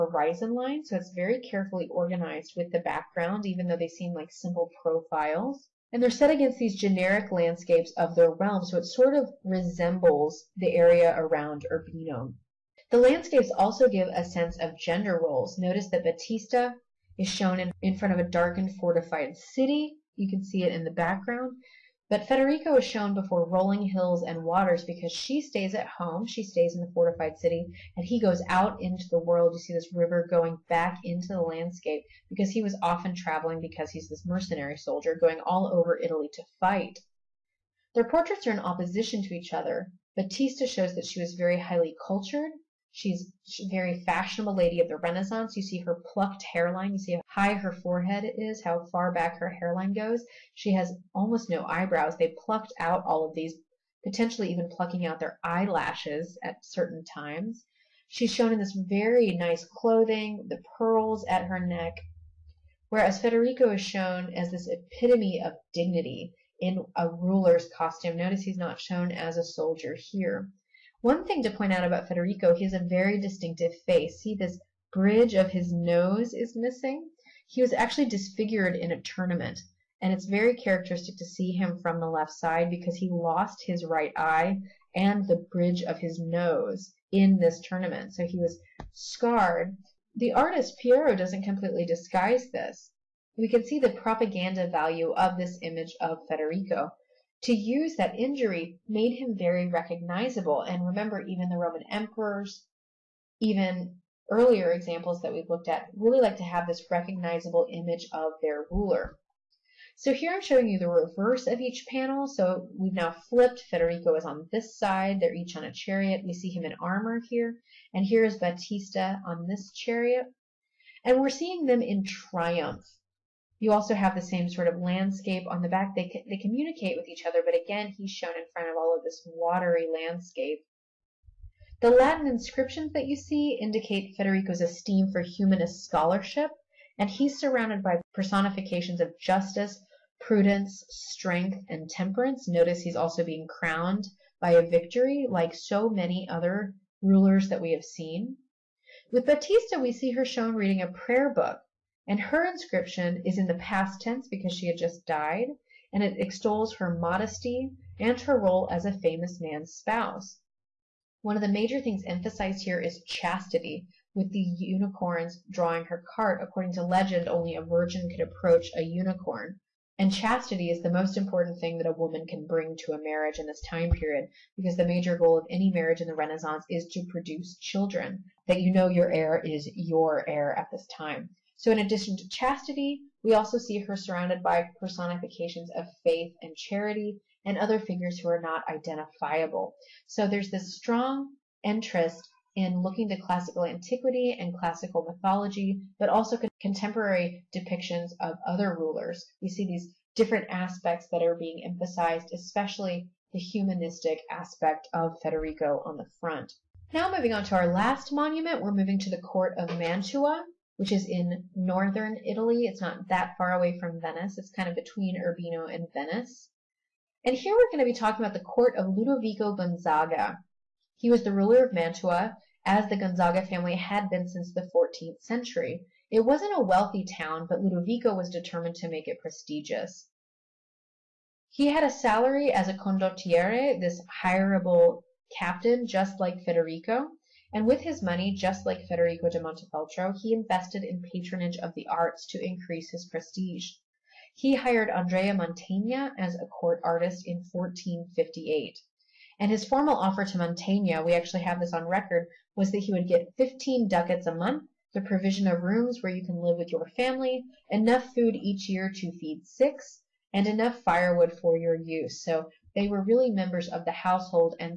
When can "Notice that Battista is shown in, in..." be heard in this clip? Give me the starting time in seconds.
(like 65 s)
15 s.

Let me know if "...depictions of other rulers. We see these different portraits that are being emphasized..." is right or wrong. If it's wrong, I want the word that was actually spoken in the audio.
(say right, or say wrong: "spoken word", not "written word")
wrong: "aspects", not "portraits".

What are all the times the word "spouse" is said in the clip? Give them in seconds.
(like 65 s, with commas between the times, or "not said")
159 s.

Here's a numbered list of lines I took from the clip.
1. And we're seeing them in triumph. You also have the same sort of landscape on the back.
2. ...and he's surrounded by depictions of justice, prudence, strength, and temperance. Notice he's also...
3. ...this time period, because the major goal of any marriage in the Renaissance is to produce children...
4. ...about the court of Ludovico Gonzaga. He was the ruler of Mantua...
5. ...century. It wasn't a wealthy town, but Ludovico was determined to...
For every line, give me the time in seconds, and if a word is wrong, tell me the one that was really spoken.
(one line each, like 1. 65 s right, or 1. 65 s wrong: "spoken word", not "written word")
1. 121 s right
2. 136 s wrong: "personifications", not "depictions"
3. 173 s right
4. 218 s right
5. 225 s right.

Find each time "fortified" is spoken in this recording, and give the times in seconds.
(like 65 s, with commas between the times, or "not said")
18 s, 26 s.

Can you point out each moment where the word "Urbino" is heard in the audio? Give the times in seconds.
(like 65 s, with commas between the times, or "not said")
11 s, 215 s.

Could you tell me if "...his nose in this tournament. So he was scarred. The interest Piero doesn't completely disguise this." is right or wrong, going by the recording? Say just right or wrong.
wrong.